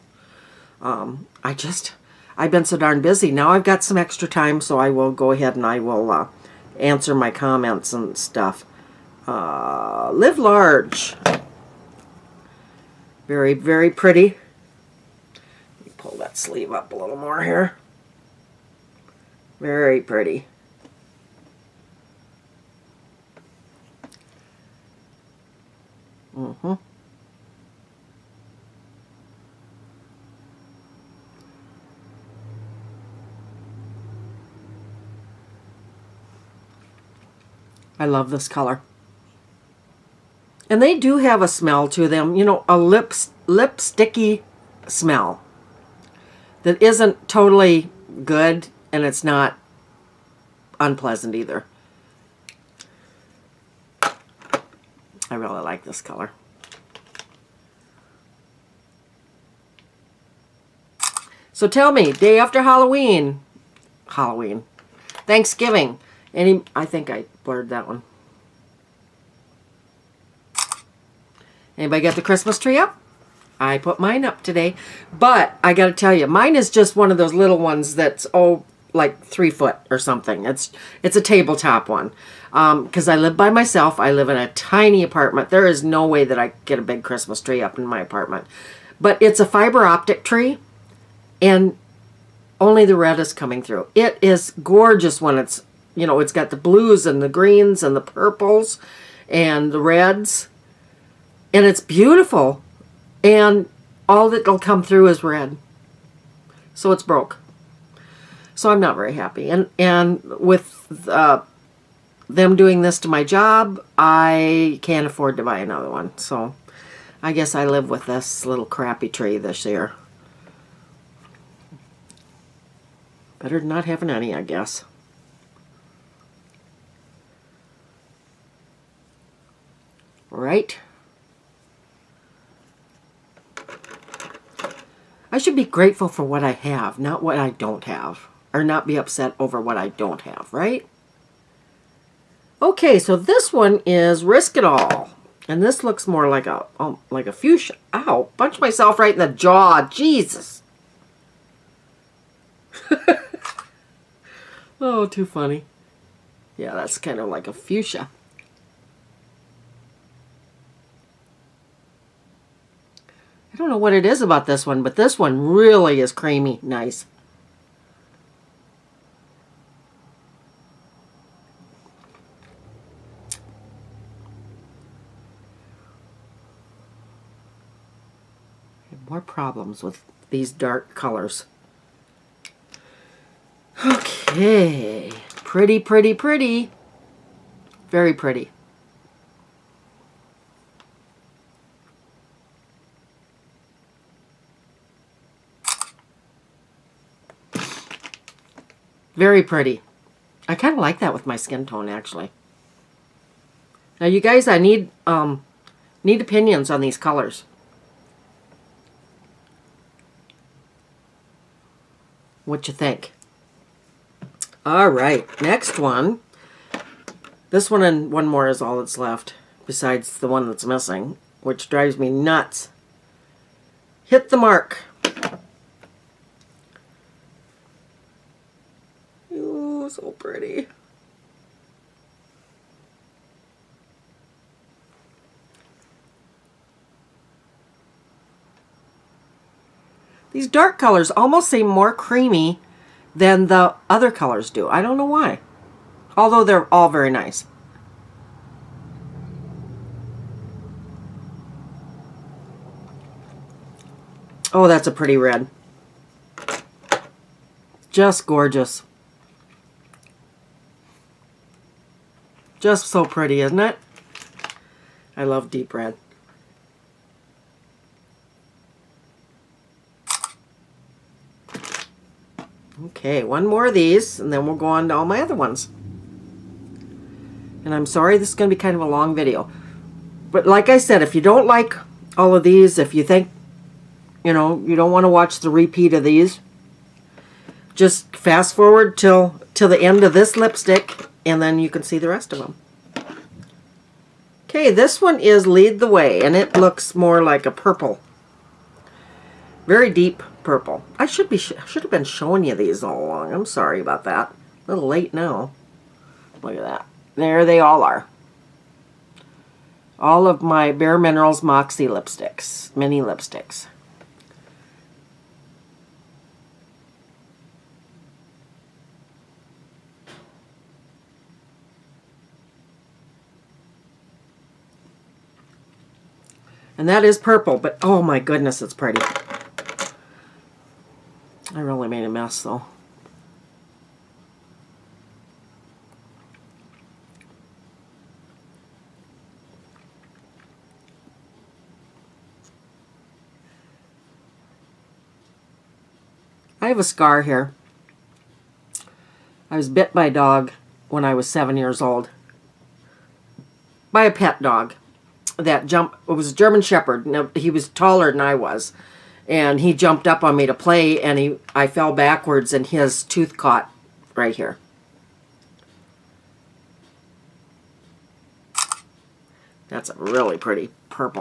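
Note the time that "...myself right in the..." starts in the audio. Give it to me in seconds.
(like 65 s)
148 s.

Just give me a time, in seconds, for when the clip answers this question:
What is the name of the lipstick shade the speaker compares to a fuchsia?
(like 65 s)
144 s.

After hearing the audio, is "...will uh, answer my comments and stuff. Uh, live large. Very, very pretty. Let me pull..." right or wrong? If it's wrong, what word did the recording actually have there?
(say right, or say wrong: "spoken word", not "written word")
right.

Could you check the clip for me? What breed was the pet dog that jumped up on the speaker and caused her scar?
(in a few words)
German Shepherd.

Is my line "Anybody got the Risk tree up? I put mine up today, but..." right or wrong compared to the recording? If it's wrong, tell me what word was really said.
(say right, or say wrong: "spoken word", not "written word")
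wrong: "Christmas", not "Risk".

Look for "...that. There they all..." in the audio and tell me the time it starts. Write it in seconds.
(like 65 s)
306 s.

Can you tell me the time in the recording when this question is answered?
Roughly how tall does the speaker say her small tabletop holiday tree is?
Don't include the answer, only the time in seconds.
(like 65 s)
79 s.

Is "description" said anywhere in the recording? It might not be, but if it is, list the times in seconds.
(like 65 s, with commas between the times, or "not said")
not said.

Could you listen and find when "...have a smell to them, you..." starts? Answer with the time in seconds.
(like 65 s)
41 s.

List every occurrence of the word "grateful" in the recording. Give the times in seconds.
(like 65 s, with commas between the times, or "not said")
135 s.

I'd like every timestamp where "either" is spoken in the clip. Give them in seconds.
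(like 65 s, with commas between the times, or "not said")
51 s.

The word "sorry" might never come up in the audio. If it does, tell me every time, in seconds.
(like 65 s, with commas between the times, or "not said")
277 s, 303 s.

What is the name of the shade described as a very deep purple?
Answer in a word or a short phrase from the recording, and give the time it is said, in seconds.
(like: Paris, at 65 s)
Lead the Way, at 295 s.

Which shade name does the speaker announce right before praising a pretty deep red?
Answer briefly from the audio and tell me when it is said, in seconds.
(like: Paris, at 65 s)
Hit the mark, at 224 s.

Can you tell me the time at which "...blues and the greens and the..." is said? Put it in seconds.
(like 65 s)
96 s.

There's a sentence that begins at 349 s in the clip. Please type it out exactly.
I was bit by a dog when I was seven years old.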